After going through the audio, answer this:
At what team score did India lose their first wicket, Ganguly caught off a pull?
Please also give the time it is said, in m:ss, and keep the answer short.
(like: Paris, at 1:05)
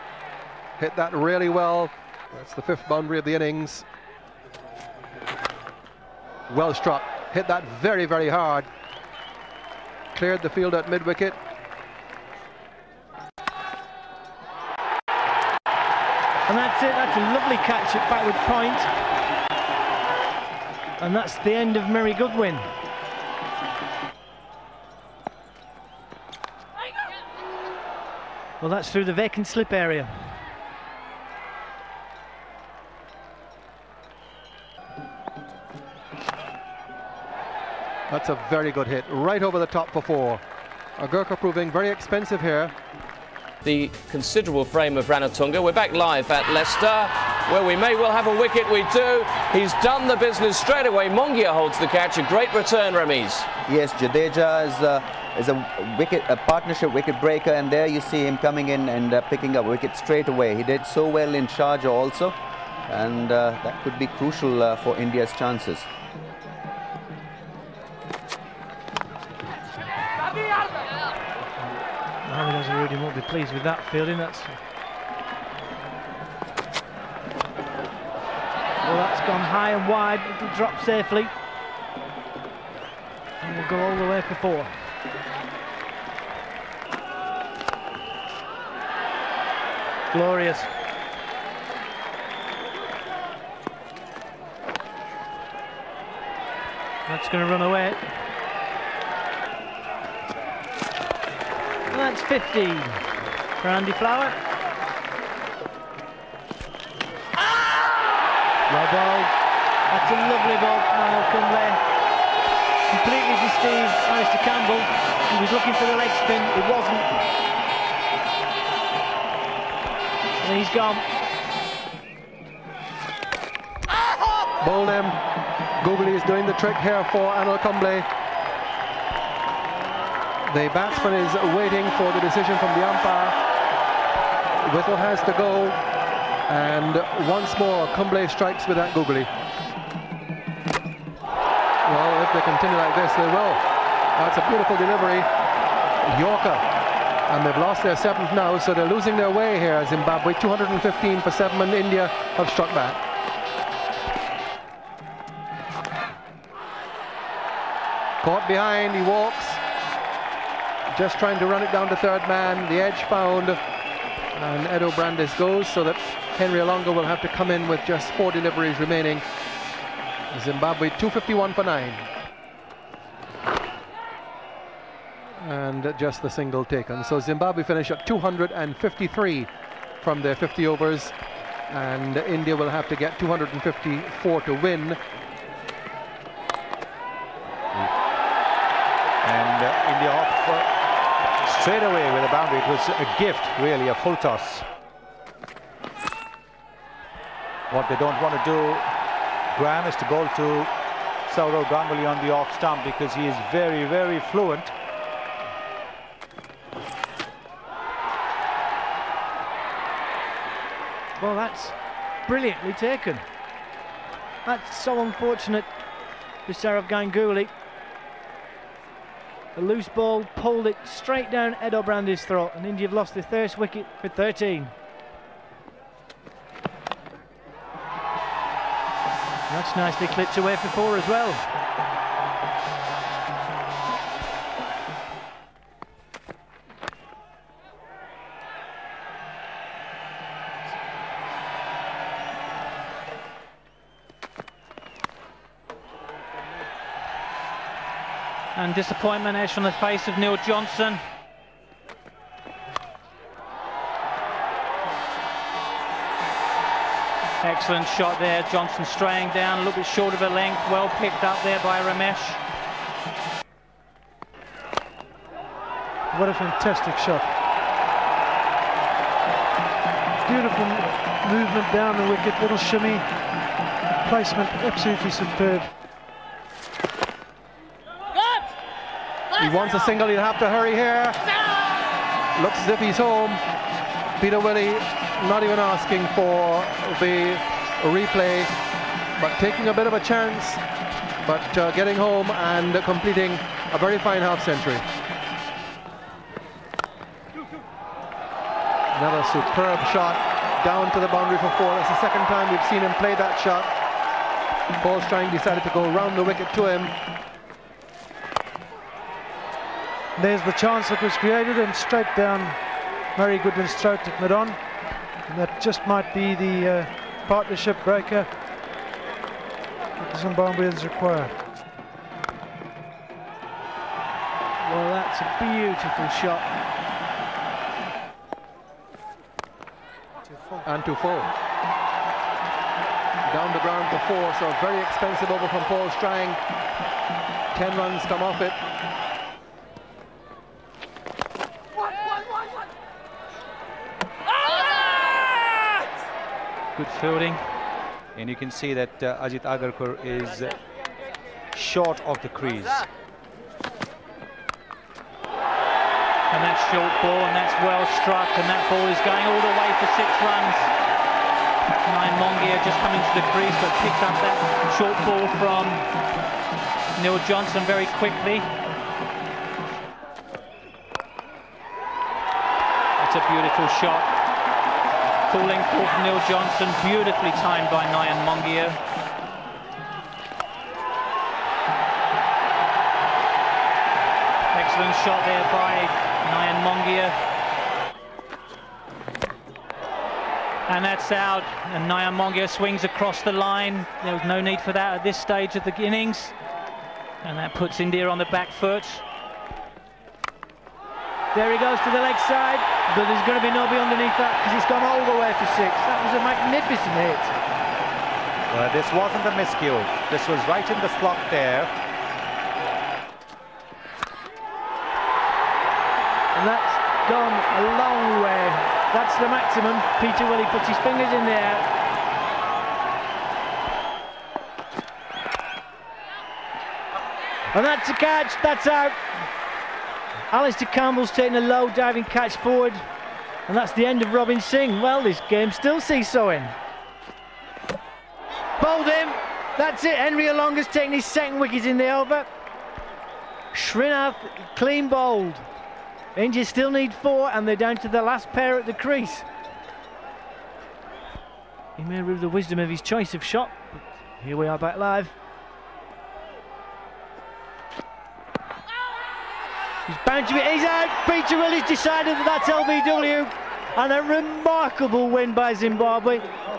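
13, at 3:44.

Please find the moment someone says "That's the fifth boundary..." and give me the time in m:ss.
0:02.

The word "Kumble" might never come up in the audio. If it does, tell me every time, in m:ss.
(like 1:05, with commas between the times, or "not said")
2:07, 2:17.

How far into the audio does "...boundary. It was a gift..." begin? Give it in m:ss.
3:12.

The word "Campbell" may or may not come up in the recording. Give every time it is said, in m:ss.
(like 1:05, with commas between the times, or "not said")
1:54, 7:10.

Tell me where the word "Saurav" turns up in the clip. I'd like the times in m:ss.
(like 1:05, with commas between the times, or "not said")
3:21.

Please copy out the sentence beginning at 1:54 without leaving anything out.
He was looking for the leg spin, it wasn't.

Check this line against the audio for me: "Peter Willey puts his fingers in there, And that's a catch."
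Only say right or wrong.
right.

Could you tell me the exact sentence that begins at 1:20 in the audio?
It'll drop safely, and will go all the way for four.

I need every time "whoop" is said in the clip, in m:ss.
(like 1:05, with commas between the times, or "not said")
not said.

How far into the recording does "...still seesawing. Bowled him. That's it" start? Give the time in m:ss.
7:15.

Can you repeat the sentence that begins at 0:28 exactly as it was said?
Well, that's through the vacant slip area.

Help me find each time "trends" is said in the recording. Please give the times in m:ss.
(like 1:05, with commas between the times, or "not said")
not said.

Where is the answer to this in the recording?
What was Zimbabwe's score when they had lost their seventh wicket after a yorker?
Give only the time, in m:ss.
2:30.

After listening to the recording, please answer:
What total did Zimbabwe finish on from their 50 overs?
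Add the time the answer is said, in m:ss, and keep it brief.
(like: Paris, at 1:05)
253, at 2:58.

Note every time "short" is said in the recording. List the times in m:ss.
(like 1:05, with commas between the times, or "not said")
4:19, 5:51, 5:56, 6:04.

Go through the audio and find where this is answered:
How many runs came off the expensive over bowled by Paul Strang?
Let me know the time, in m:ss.
5:37.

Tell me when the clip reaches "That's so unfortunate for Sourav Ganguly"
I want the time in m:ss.
3:34.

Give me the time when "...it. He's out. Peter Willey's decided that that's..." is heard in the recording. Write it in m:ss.
7:40.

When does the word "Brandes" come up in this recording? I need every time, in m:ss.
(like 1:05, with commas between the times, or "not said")
2:44, 3:41.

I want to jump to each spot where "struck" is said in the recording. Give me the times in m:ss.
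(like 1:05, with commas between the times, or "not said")
0:06, 2:32, 5:58.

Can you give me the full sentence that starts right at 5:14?
And that just might be the uh, partnership breaker that the Zimbabweans require.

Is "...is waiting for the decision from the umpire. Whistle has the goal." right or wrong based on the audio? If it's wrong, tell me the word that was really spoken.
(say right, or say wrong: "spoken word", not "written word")
right.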